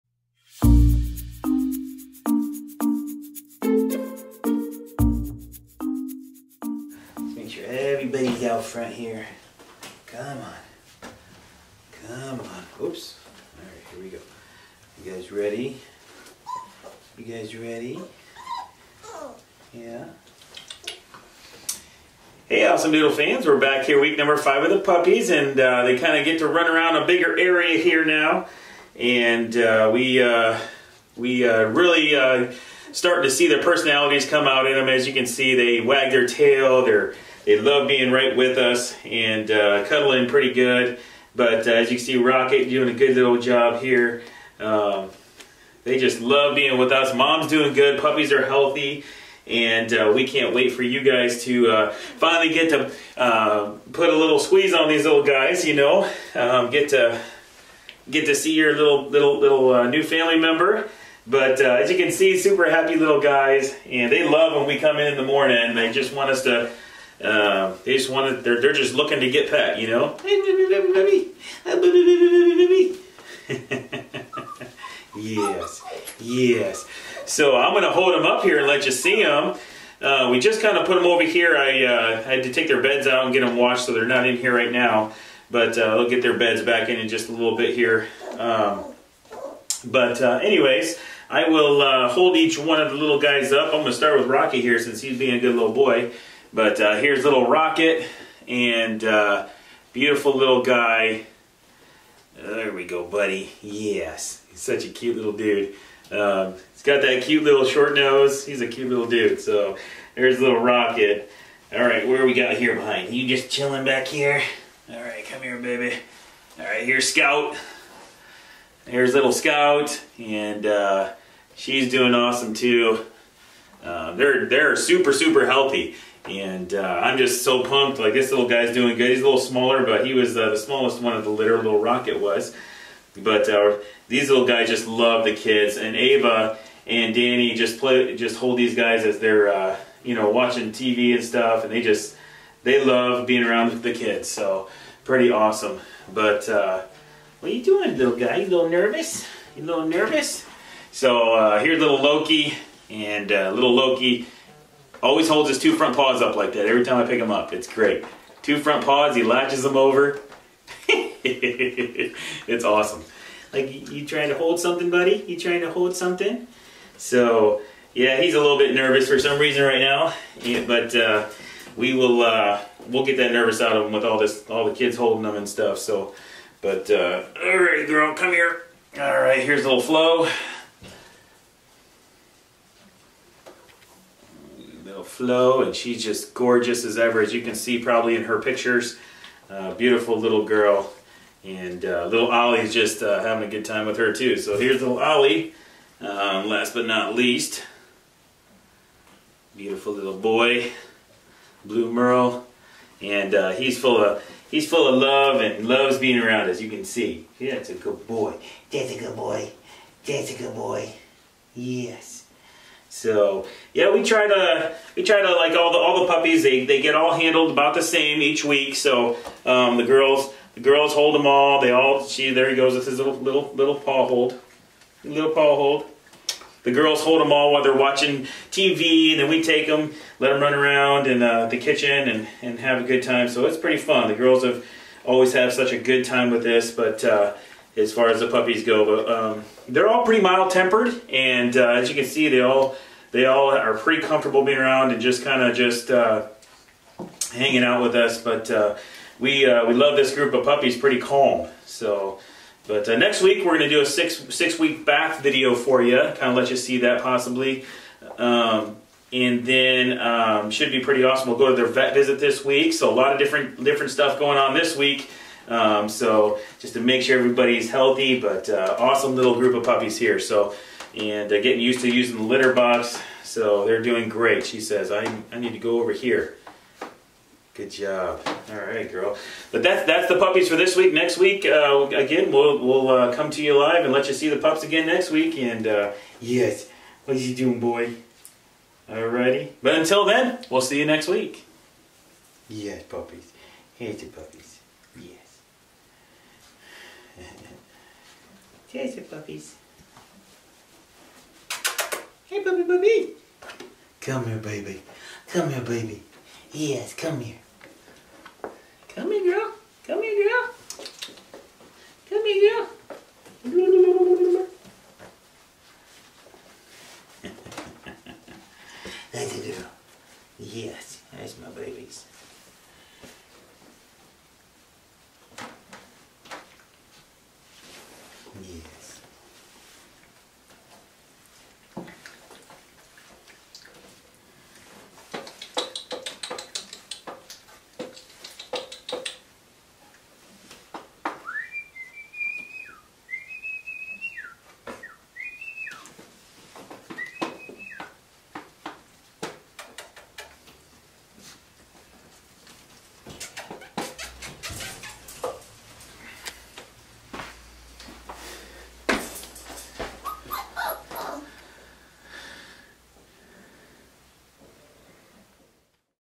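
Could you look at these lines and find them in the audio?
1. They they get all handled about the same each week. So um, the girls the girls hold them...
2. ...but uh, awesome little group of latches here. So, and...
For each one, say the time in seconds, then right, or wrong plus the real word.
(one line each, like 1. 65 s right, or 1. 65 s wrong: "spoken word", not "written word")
1. 216 s right
2. 268 s wrong: "puppies", not "latches".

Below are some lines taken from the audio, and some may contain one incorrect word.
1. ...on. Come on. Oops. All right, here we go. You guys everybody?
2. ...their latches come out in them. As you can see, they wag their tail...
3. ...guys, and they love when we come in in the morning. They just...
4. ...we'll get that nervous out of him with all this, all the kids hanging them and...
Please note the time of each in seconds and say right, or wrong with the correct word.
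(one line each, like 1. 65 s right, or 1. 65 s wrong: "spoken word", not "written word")
1. 10 s wrong: "ready", not "everybody"
2. 33 s wrong: "personalities", not "latches"
3. 63 s right
4. 172 s wrong: "holding", not "hanging".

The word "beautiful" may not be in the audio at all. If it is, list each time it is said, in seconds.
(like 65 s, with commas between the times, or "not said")
99 s, 189 s, 199 s.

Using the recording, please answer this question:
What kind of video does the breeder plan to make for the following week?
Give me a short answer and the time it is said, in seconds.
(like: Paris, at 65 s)
six week bath video, at 253 s.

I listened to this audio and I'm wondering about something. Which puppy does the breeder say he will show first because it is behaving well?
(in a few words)
Rocky.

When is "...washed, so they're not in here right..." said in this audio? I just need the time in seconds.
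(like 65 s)
83 s.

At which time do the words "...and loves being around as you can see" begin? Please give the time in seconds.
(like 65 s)
205 s.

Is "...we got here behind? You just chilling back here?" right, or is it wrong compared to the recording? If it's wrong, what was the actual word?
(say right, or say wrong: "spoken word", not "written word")
right.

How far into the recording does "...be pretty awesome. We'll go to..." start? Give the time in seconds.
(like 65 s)
260 s.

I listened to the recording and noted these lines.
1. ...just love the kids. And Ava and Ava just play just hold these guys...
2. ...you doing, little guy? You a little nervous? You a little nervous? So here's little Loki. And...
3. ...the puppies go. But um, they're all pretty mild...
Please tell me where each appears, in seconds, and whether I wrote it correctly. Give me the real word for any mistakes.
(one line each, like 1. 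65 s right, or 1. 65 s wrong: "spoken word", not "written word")
1. 134 s wrong: "Danny", not "Ava"
2. 147 s right
3. 238 s right.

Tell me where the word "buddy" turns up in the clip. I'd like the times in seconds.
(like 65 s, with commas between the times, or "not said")
103 s, 164 s.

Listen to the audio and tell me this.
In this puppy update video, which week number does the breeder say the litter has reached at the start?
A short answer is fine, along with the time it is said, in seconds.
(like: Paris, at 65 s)
5, at 24 s.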